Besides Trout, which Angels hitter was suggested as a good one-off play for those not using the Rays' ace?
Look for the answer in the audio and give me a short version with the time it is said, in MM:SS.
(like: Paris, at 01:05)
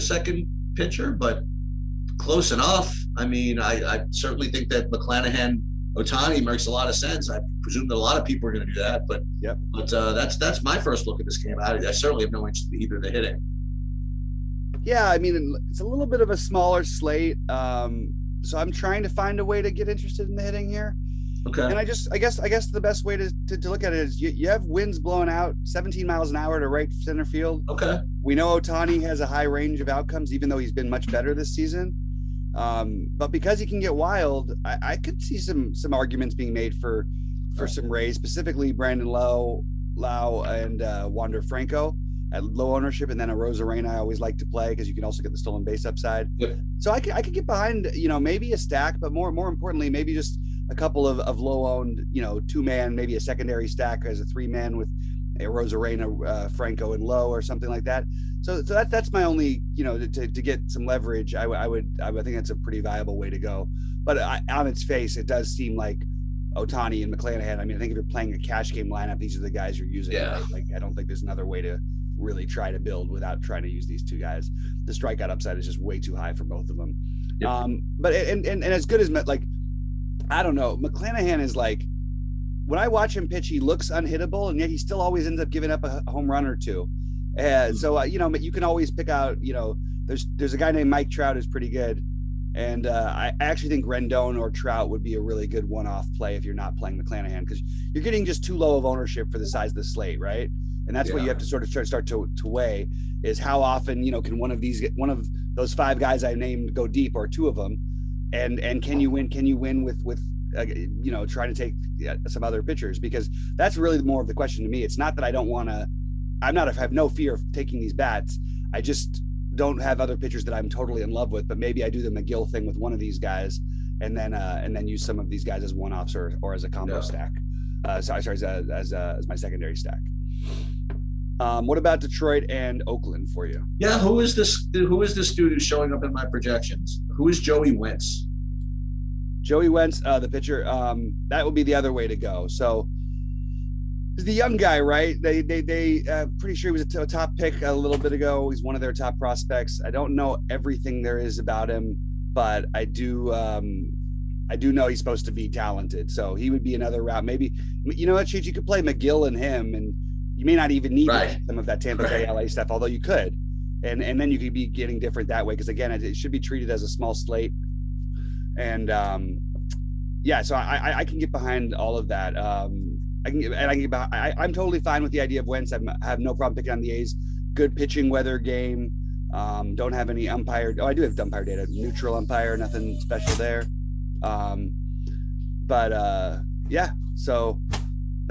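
Rendon, at 01:33.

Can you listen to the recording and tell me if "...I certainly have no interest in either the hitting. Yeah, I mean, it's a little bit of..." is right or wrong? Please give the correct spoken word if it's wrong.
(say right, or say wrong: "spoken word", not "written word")
right.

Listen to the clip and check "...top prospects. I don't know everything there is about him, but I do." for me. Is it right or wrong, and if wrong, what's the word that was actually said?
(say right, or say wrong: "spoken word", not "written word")
right.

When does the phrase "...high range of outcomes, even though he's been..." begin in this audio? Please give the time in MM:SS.
00:29.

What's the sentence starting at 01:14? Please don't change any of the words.
The strikeout upside is just way too high for both of them.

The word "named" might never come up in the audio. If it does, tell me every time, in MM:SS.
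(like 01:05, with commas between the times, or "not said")
01:30, 01:46.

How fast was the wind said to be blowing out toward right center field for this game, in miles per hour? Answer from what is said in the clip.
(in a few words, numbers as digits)
17.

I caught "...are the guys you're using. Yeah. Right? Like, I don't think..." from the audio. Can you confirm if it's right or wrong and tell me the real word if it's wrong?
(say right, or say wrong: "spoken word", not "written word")
right.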